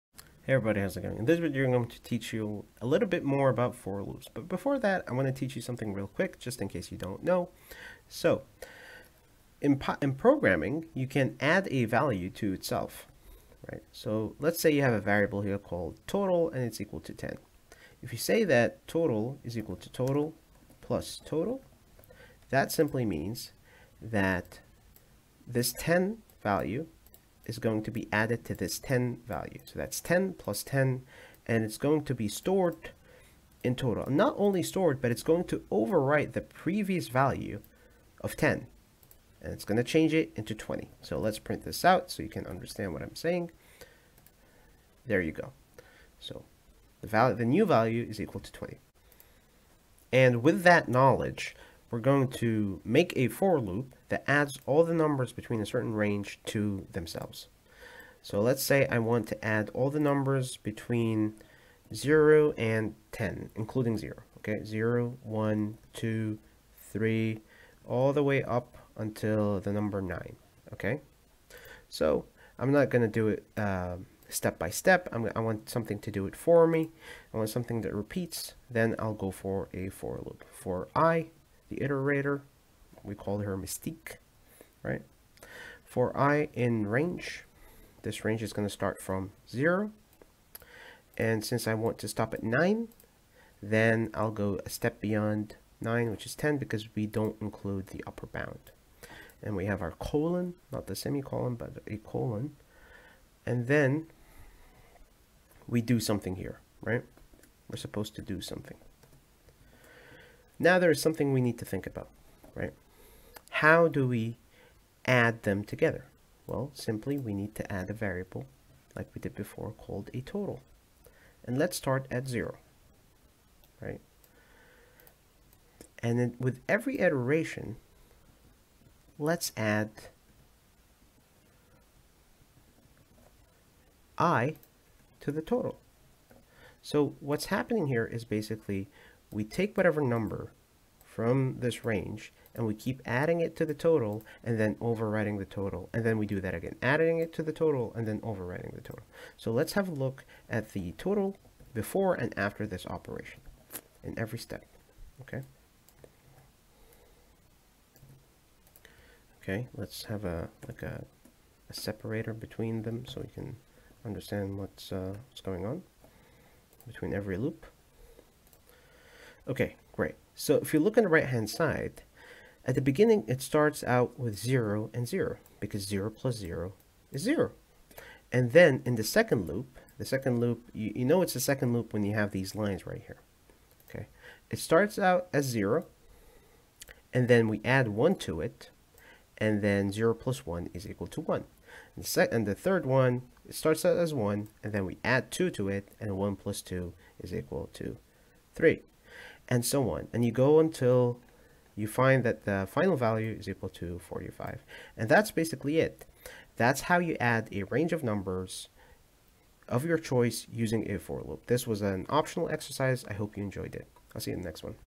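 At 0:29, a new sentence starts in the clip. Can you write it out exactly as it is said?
So that's 10 plus 10, and it's going to be stored in total.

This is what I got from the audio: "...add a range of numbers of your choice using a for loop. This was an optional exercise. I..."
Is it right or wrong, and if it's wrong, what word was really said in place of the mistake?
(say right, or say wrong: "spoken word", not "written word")
right.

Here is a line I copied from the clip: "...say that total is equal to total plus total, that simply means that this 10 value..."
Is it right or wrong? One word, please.
right.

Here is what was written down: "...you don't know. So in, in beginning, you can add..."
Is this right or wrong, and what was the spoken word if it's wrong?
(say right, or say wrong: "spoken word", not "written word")
wrong: "programming", not "beginning".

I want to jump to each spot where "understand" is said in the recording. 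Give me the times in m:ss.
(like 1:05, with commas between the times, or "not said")
0:42, 2:44.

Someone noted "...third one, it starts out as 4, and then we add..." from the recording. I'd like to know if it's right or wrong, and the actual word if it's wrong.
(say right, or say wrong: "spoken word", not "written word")
wrong: "1", not "4".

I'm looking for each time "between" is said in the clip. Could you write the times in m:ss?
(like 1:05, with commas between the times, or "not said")
0:55, 1:00, 2:42, 2:46.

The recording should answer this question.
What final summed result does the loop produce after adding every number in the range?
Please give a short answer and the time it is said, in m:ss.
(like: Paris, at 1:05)
45, at 3:24.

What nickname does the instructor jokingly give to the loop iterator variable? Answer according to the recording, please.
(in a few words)
Mystique.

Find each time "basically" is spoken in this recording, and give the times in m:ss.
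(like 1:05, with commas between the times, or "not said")
2:18, 3:25.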